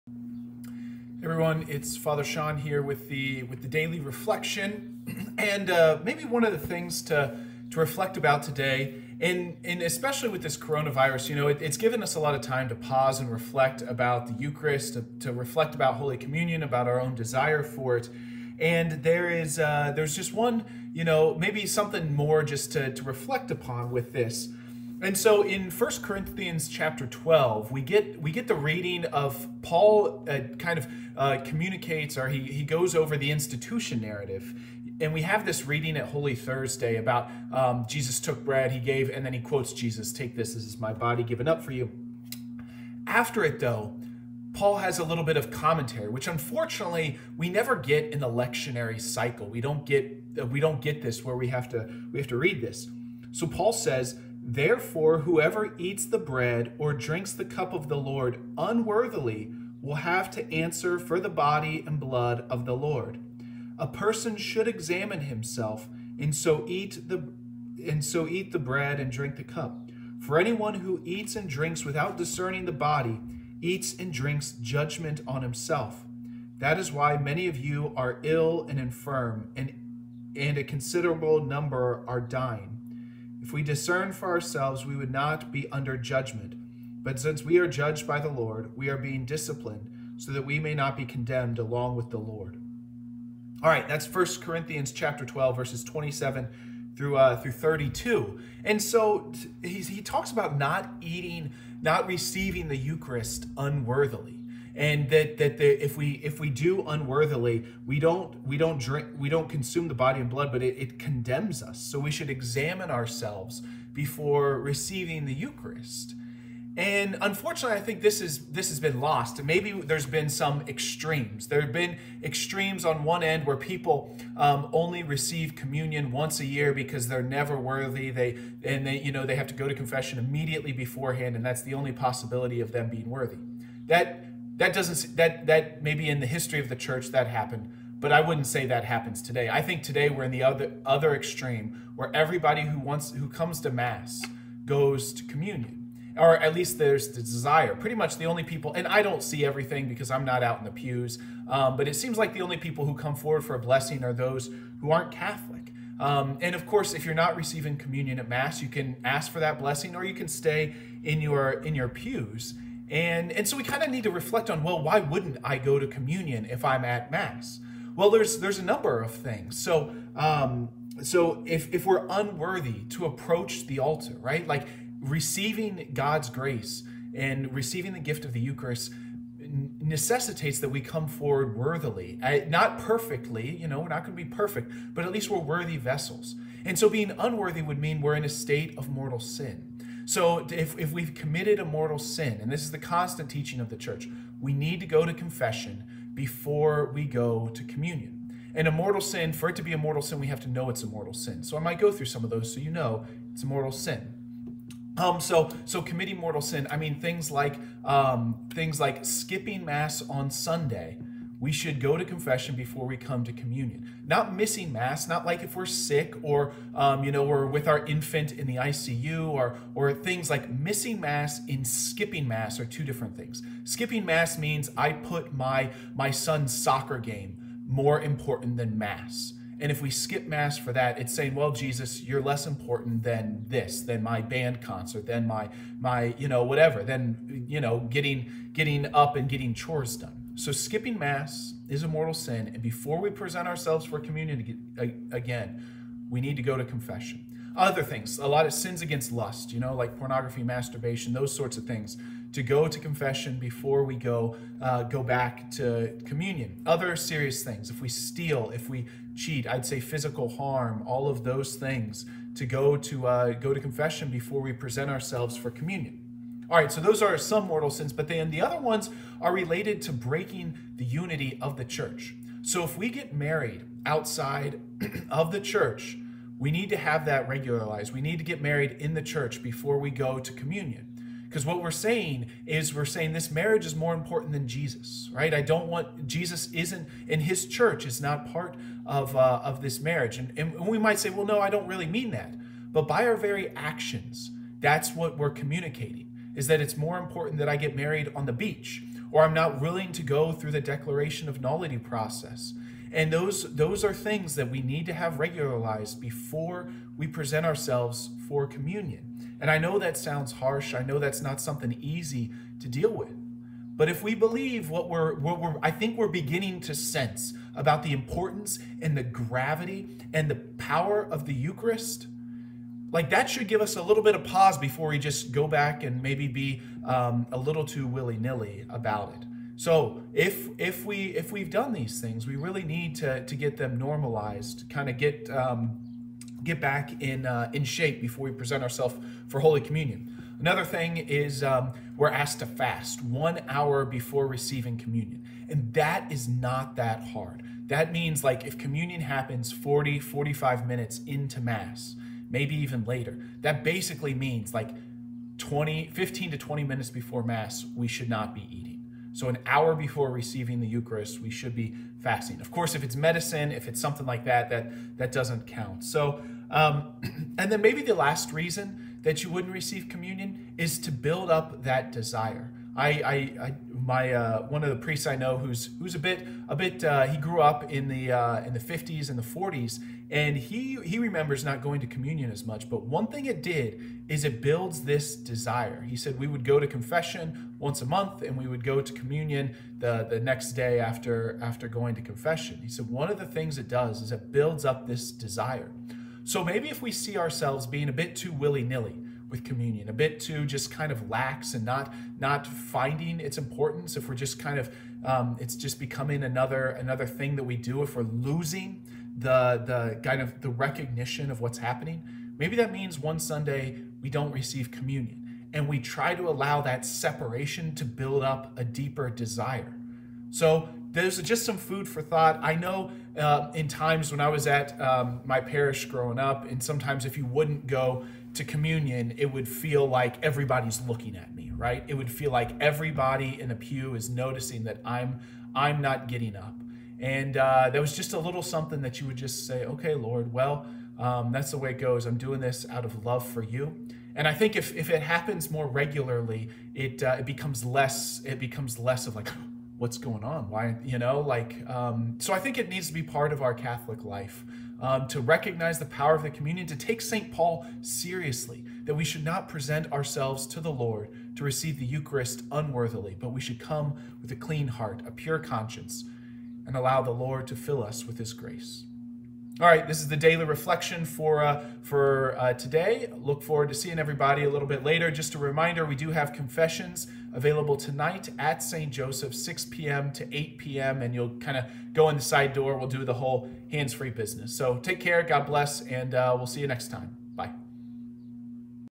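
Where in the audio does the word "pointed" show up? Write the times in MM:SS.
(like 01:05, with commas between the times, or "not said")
not said.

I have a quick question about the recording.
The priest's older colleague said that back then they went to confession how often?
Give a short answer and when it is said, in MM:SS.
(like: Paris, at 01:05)
Once a month, at 06:27.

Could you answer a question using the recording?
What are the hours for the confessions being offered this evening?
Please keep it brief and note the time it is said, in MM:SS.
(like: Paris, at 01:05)
6 p.m. to 8 p.m., at 07:59.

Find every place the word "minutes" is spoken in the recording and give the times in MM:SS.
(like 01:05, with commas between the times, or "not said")
05:50, 05:56.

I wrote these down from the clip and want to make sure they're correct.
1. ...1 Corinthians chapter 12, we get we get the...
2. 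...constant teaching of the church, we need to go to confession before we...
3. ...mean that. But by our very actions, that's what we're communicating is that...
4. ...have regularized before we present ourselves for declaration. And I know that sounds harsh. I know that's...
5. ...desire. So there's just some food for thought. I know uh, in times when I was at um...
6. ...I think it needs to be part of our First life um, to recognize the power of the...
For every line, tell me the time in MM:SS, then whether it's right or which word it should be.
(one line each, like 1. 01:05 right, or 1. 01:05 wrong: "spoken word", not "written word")
1. 00:25 right
2. 03:12 right
3. 04:51 right
4. 05:04 wrong: "communion", not "declaration"
5. 06:59 right
6. 07:32 wrong: "Catholic", not "First".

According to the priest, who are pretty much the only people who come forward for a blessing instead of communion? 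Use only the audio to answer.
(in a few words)
Those who aren't Catholic.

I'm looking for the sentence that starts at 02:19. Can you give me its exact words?
I think today we're in the other other extreme where everybody who wants who comes to mass goes to communion.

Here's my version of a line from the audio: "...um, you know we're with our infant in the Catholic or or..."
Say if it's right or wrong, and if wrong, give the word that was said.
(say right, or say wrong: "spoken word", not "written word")
wrong: "ICU", not "Catholic".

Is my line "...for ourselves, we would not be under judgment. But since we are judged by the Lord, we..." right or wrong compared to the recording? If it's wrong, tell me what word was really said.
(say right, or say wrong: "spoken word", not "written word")
right.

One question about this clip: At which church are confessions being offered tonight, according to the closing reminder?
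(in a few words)
St. Joseph.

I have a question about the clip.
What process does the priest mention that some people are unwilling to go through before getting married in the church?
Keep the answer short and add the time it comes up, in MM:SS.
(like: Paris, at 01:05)
Declaration of nullity, at 05:00.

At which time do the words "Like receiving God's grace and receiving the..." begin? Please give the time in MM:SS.
02:54.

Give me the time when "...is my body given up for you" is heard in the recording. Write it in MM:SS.
00:40.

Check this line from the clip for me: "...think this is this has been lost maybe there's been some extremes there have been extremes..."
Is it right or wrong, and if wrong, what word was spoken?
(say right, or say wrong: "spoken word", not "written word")
right.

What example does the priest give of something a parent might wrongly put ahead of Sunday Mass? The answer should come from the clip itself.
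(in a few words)
Son's soccer game.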